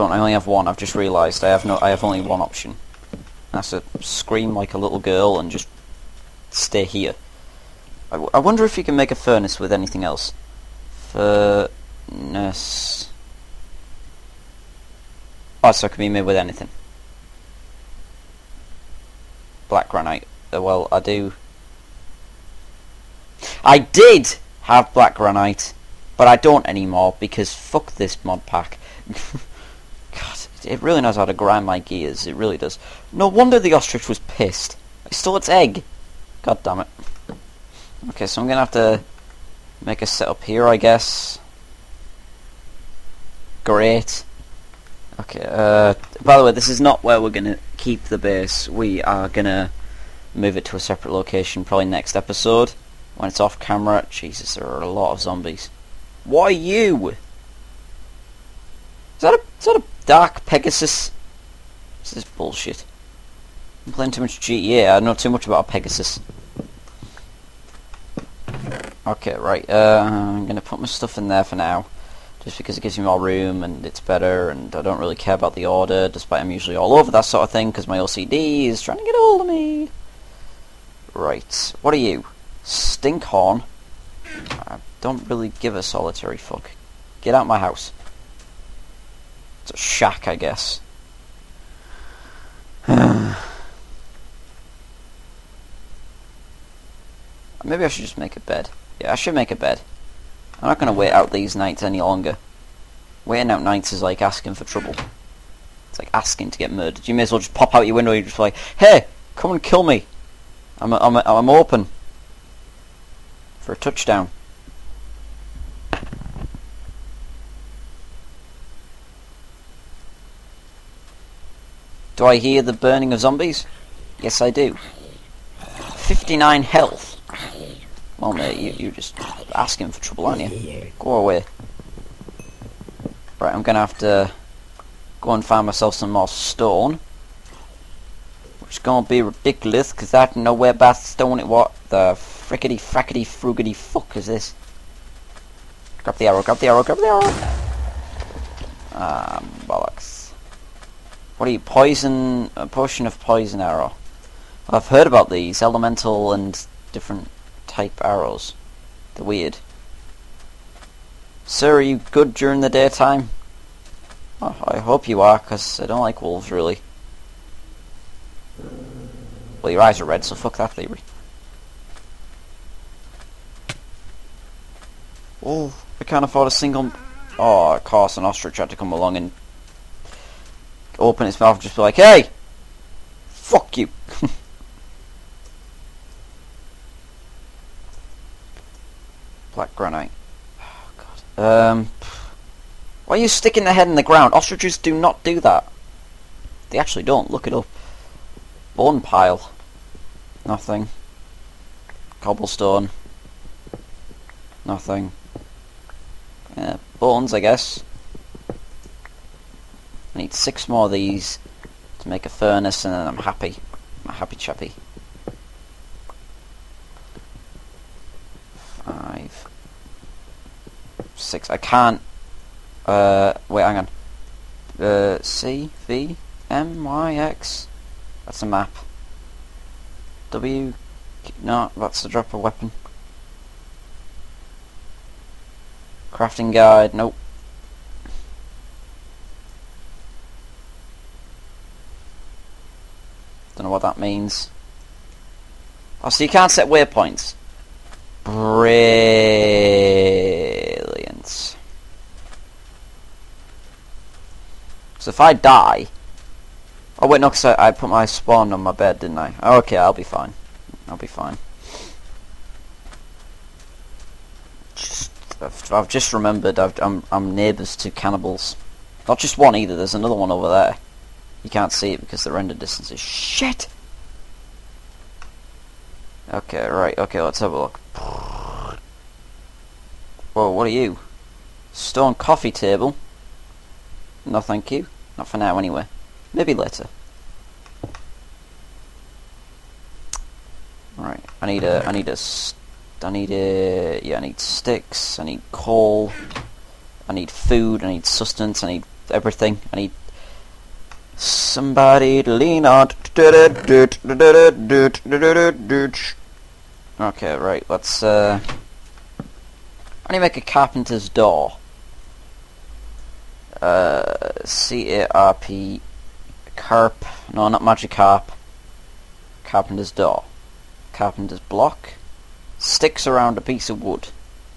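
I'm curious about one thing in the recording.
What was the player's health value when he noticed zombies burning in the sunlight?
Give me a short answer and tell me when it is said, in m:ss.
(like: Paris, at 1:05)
59, at 2:05.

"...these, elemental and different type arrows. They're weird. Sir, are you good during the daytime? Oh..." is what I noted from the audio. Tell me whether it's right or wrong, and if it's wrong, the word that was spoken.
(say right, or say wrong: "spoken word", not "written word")
right.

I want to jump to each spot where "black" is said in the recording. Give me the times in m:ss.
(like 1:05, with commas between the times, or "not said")
0:19, 0:24, 3:09.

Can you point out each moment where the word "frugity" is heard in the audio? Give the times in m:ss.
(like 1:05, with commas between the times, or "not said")
2:23.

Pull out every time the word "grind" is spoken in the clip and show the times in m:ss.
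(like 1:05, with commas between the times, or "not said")
0:31.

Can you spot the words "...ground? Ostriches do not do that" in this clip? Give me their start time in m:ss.
3:14.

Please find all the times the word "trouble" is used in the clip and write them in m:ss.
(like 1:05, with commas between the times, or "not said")
1:44, 2:09.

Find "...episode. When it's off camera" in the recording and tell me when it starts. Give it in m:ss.
0:52.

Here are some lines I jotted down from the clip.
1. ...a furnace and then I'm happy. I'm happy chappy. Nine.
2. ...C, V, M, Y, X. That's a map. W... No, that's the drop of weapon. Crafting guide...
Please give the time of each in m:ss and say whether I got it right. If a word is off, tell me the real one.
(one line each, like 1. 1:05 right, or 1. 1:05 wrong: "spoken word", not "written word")
1. 3:32 wrong: "Five", not "Nine"
2. 3:45 right.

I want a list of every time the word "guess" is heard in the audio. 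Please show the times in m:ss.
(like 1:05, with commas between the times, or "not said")
0:40, 1:30, 3:27.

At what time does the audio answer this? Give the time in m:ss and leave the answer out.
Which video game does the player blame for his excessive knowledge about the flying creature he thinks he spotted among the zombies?
1:04.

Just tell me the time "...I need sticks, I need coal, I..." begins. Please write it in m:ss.
4:54.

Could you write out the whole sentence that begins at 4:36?
Okay, right, okay, let's have a look.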